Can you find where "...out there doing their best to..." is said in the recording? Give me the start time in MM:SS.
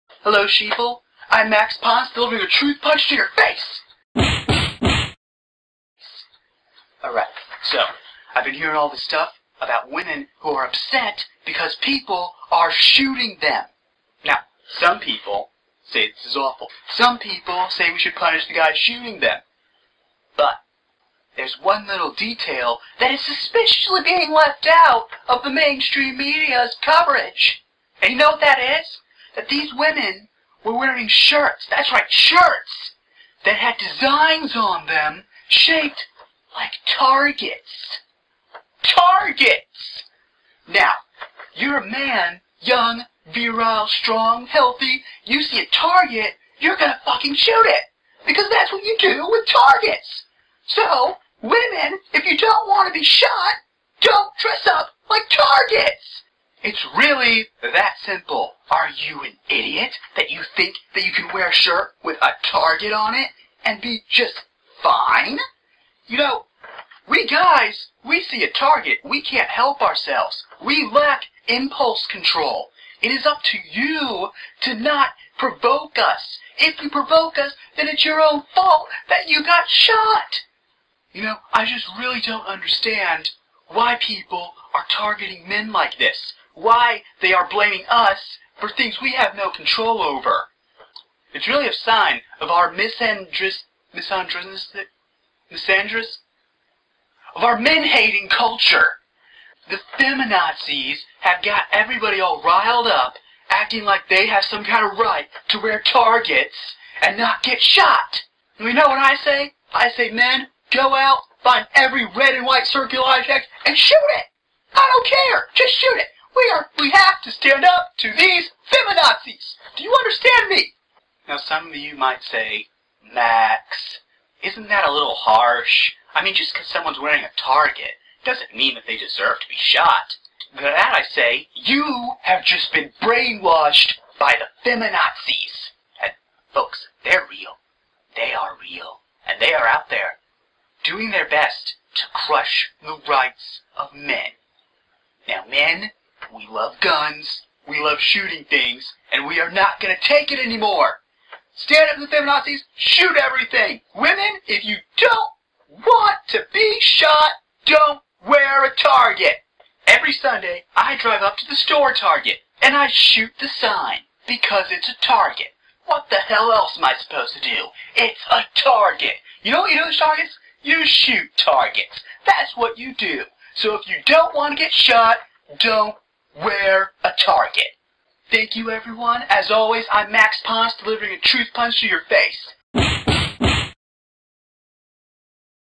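02:19.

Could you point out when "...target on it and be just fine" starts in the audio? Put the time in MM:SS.
01:02.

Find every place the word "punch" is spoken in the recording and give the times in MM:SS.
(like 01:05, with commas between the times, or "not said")
00:02, 03:01.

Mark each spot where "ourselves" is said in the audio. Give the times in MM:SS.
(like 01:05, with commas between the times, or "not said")
01:09.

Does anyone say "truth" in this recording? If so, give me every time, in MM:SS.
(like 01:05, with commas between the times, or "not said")
00:02, 03:01.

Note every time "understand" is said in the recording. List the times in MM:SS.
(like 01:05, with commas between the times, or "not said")
01:22, 01:59.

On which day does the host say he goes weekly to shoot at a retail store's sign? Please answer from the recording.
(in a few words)
Sunday.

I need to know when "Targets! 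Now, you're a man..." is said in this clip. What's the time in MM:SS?
00:38.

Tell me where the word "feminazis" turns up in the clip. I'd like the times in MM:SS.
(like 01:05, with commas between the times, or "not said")
01:39, 01:58, 02:14, 02:32.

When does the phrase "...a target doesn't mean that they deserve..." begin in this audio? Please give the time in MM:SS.
02:07.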